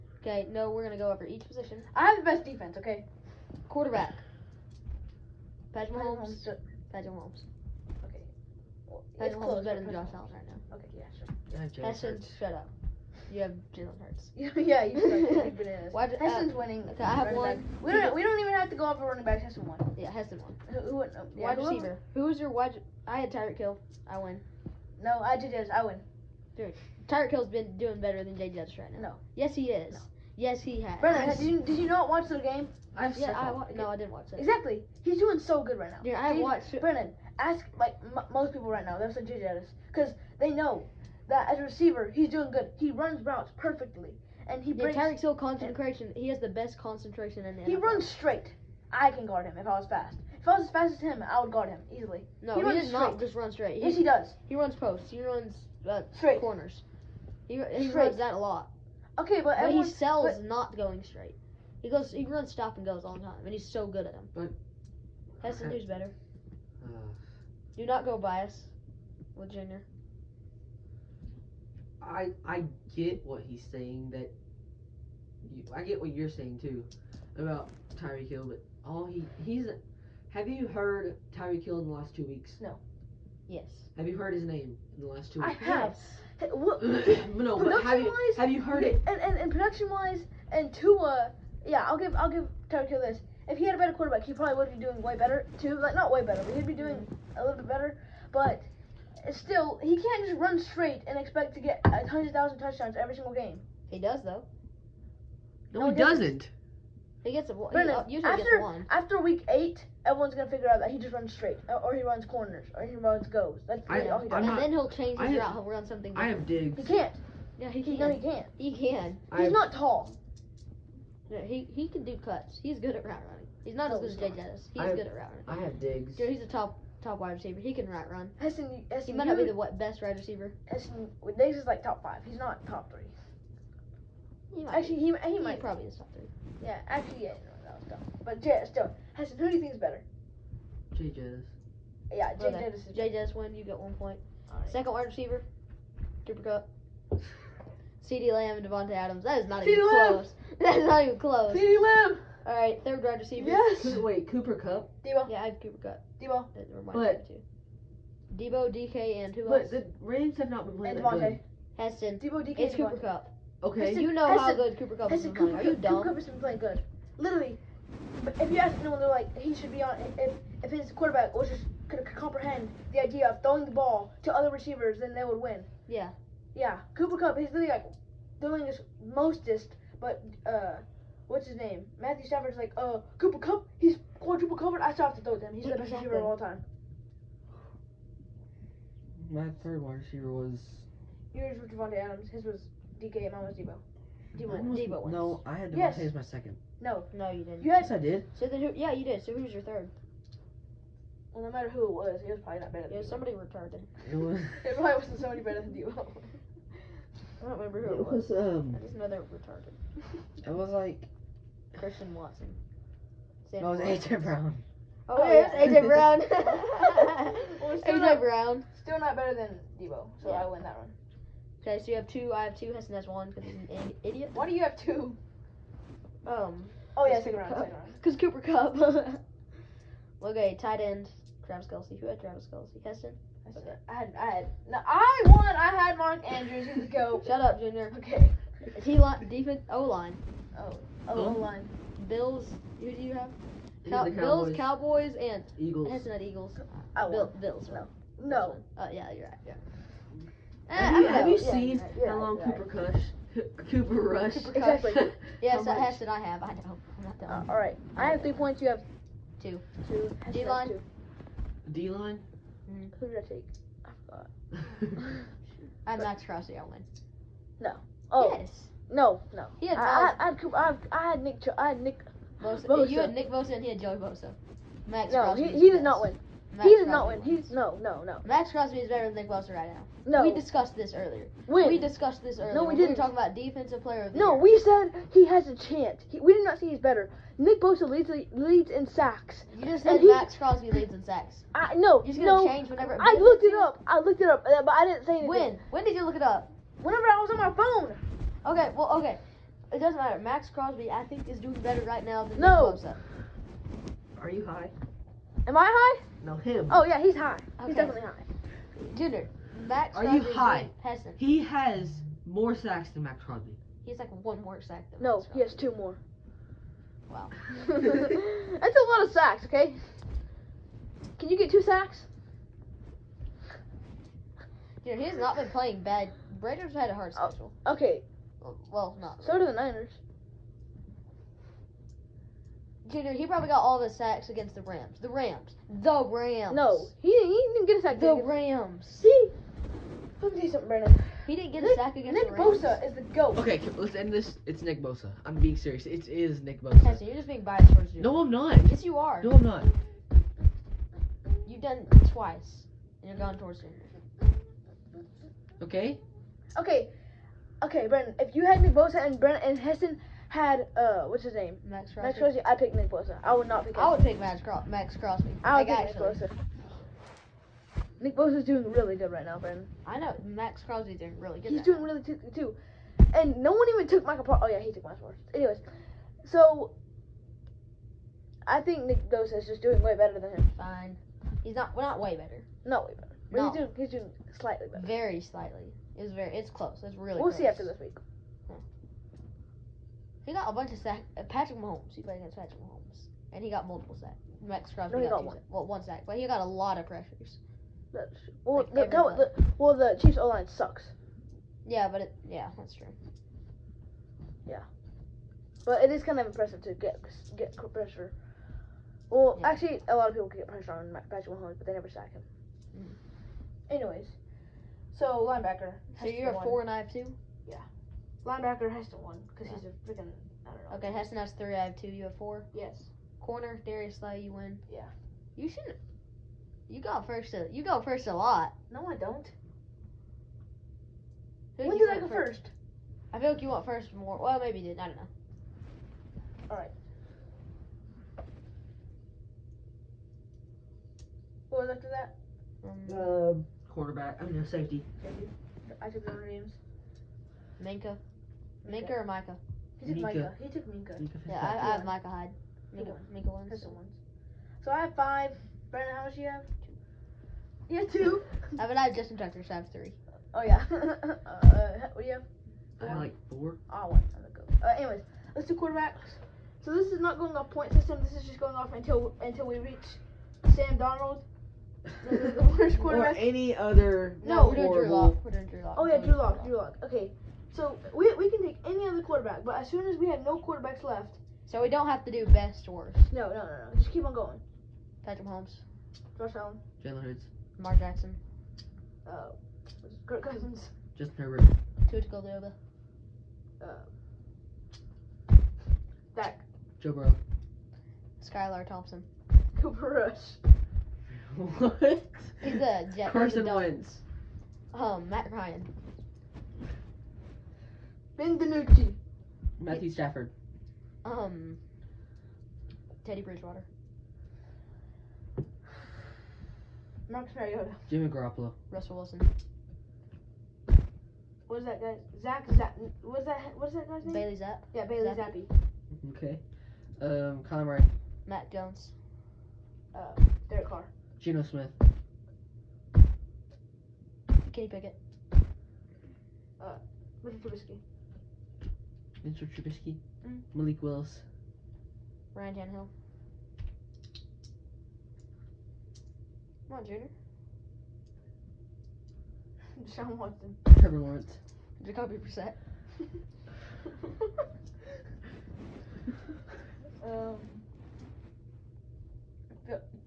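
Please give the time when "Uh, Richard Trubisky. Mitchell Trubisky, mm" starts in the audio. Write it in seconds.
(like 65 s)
536 s.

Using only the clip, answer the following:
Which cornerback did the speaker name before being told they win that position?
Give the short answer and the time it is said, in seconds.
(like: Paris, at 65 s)
Darius Slay, at 423 s.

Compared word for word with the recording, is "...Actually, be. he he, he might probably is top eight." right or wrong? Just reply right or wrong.
wrong.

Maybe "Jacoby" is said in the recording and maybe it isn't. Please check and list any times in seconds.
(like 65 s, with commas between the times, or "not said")
551 s.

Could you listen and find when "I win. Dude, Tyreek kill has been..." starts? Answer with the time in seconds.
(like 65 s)
25 s.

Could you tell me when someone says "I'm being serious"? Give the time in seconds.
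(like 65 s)
345 s.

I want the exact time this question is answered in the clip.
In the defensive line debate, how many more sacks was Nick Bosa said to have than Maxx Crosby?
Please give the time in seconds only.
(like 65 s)
315 s.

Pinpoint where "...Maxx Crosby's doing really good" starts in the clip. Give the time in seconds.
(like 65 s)
370 s.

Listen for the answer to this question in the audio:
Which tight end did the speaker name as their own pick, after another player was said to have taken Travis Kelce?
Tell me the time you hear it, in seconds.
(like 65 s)
235 s.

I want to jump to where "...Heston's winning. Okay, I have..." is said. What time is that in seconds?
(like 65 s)
16 s.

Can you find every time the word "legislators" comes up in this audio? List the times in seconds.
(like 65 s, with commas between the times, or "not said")
not said.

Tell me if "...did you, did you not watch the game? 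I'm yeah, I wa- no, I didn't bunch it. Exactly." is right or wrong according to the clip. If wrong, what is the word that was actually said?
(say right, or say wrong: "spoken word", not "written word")
wrong: "watch", not "bunch".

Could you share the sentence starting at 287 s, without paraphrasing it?
Nick Bosa leads leads in sacks.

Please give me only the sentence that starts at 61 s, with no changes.
He goes, he runs stop and goes all the time, and he's so good at them.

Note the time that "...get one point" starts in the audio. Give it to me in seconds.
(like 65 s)
143 s.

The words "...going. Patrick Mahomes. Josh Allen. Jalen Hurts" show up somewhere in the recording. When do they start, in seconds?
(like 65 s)
484 s.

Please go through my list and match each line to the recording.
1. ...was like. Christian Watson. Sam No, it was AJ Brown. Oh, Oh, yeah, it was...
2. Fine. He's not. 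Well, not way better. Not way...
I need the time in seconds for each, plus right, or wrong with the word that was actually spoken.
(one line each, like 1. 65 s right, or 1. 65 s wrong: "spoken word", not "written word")
1. 210 s right
2. 380 s right.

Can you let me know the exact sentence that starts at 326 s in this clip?
Raiders had a hard oh, schedule.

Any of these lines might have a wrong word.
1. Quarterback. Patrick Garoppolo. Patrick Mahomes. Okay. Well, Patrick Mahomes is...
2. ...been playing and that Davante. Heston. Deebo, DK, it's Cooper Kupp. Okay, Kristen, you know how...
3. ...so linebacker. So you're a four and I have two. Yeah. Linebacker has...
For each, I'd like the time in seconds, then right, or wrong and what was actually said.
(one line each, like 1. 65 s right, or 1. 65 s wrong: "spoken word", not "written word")
1. 3 s wrong: "Mahomes", not "Garoppolo"
2. 160 s right
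3. 414 s right.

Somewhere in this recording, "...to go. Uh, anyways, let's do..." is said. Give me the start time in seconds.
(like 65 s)
464 s.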